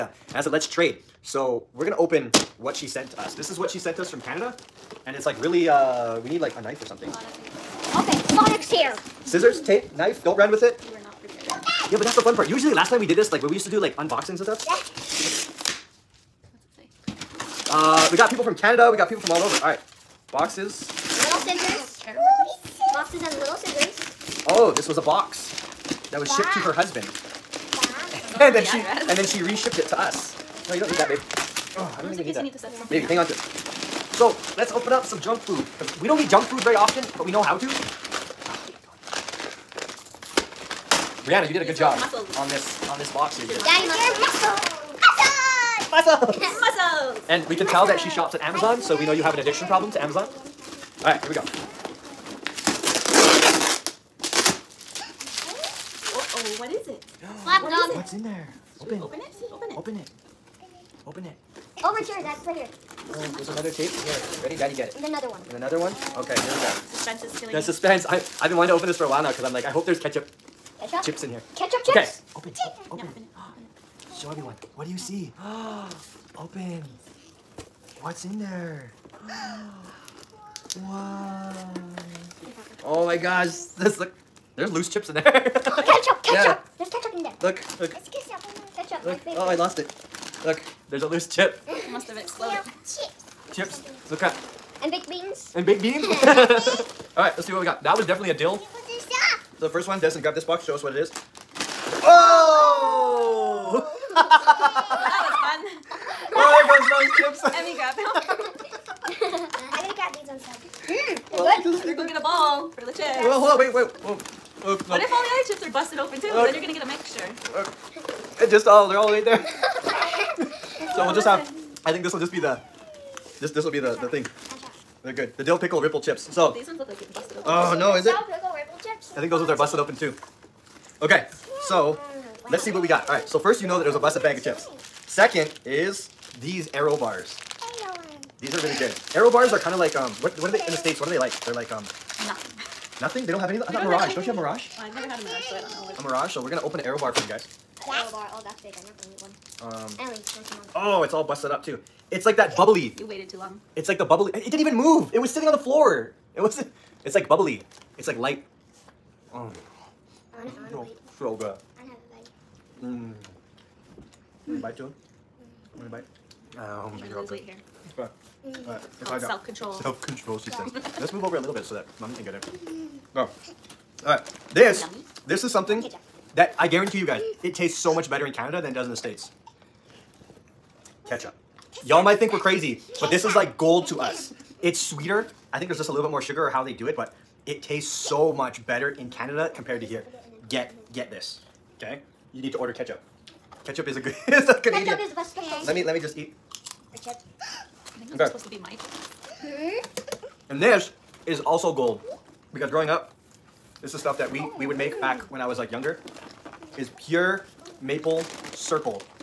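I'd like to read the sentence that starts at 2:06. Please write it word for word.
So these ones look like it's busted open.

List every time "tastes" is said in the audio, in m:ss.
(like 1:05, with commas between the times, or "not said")
2:57, 3:07.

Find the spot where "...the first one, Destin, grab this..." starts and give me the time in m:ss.
1:39.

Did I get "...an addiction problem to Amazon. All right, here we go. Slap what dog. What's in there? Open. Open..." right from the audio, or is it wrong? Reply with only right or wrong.
right.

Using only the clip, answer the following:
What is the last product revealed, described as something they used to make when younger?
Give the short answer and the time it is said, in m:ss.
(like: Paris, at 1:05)
Pure maple syrup, at 3:26.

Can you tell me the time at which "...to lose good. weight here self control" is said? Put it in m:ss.
2:47.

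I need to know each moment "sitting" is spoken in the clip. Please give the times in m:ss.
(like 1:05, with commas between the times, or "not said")
2:35.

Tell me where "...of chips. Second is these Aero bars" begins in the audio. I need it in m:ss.
2:14.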